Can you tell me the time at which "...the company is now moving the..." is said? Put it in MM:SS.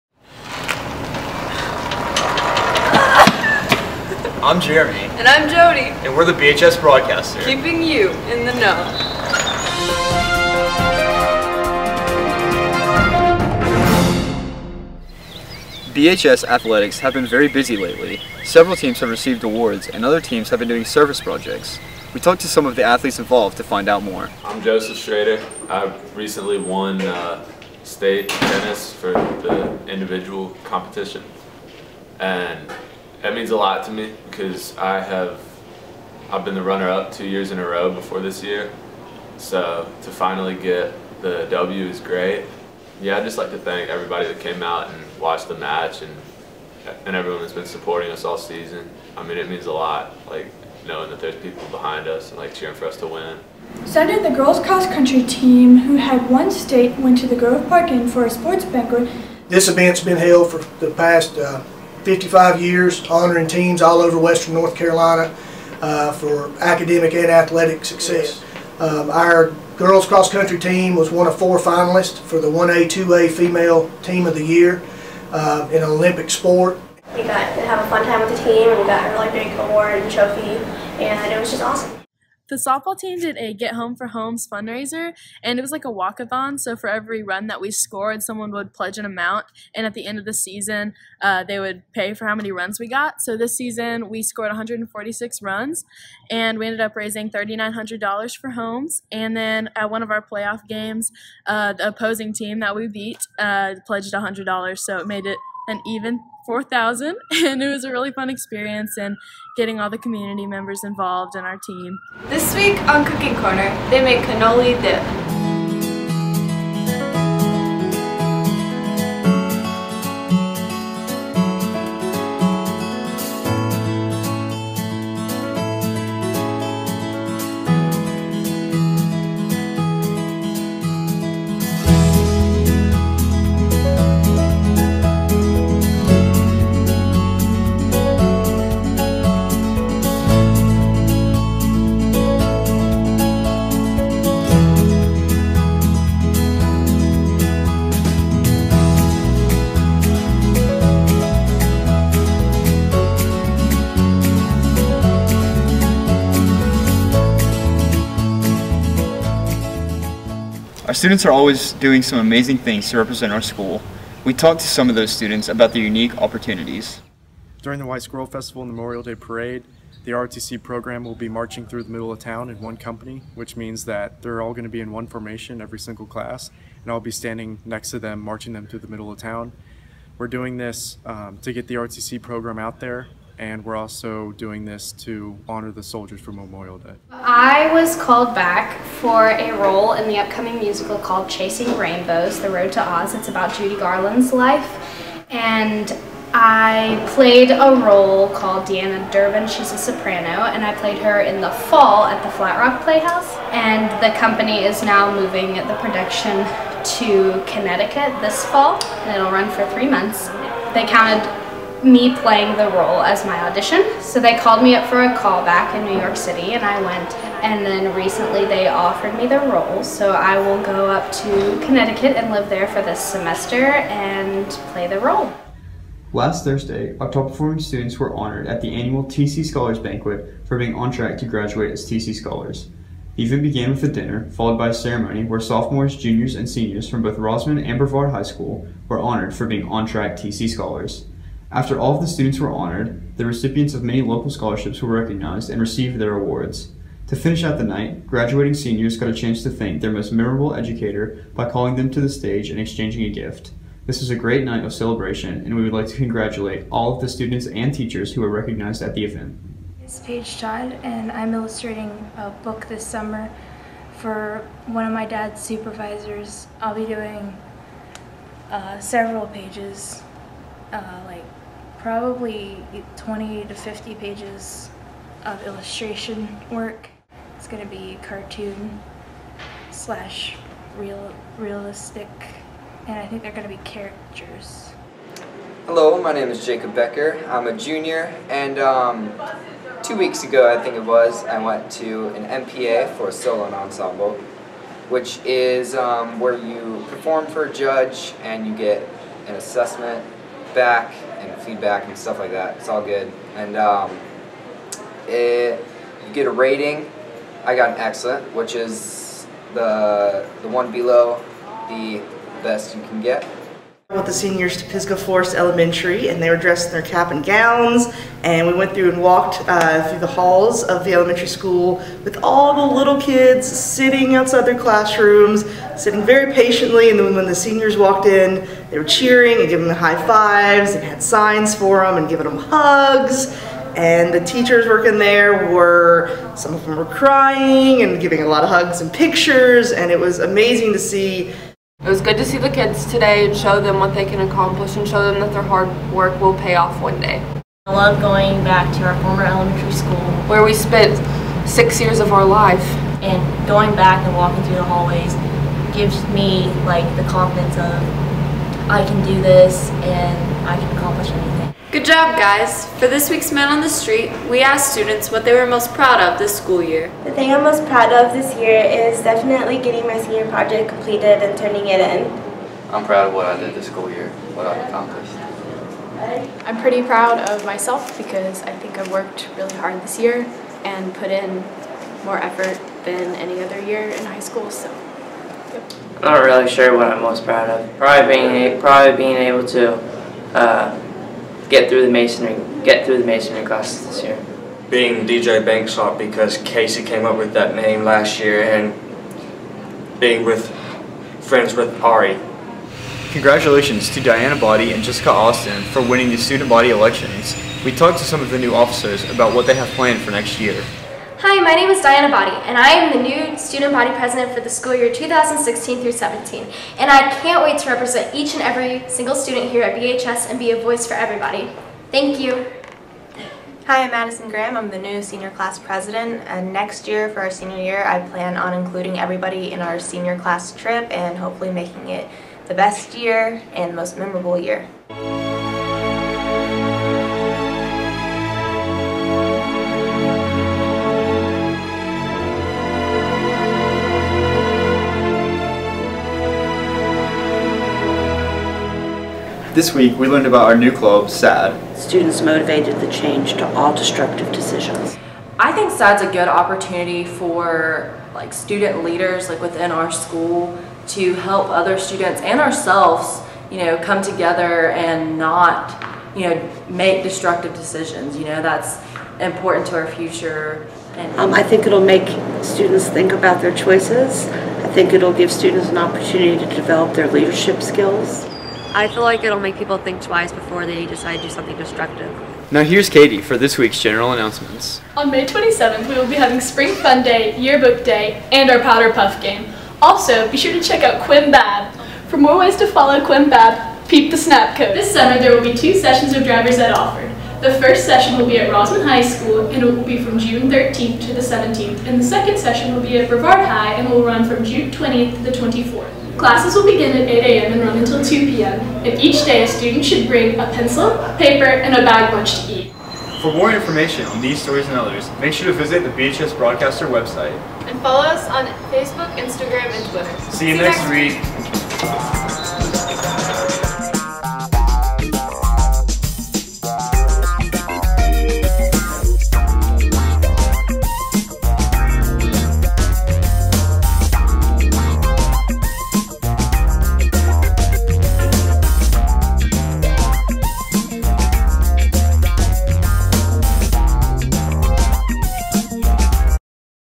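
03:24.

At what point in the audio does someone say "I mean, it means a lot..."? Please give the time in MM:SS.
00:49.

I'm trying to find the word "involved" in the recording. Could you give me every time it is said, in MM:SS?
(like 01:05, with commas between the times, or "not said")
00:23, 01:50.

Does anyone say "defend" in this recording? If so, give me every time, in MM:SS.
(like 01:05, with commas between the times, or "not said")
not said.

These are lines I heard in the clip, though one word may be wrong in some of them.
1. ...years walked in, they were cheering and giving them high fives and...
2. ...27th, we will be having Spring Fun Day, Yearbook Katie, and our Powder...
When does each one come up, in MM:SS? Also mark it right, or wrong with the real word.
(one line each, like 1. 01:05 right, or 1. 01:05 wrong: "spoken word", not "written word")
1. 05:27 wrong: "seniors", not "years"
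2. 08:05 wrong: "Day", not "Katie".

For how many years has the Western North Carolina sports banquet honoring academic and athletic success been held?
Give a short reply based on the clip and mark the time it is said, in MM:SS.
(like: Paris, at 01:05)
55, at 01:02.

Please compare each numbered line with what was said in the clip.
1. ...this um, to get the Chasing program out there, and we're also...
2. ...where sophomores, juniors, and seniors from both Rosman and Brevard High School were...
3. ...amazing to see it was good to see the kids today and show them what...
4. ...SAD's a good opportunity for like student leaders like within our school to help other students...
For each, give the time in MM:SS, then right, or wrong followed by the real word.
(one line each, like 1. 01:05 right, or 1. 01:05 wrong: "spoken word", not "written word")
1. 03:00 wrong: "ROTC", not "Chasing"
2. 03:55 right
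3. 05:40 right
4. 07:35 right.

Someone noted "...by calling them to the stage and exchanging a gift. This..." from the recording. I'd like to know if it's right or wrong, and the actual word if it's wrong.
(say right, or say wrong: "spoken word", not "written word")
right.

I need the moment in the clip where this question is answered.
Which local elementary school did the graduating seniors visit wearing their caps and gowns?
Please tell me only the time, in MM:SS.
05:14.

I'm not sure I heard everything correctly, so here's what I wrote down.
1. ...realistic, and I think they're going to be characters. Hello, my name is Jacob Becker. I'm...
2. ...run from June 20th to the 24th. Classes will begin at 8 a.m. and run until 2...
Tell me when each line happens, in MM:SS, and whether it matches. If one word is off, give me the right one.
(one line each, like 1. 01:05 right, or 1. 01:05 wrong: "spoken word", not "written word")
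1. 04:41 right
2. 08:24 right.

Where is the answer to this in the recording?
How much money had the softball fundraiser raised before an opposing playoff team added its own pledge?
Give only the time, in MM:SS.
01:37.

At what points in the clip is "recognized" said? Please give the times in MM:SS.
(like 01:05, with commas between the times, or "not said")
04:04, 04:18.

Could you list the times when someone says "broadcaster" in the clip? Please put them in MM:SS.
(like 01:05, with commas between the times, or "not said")
00:06, 08:36.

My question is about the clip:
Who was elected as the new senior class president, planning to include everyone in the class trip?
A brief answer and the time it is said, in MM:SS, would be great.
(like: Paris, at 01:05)
Madison Graham, at 07:03.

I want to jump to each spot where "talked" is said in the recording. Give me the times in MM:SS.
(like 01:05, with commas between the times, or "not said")
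00:22, 02:44, 06:47.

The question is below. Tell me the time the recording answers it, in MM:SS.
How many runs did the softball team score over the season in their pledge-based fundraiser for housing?
01:34.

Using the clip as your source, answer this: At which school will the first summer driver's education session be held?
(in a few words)
Rosman High School.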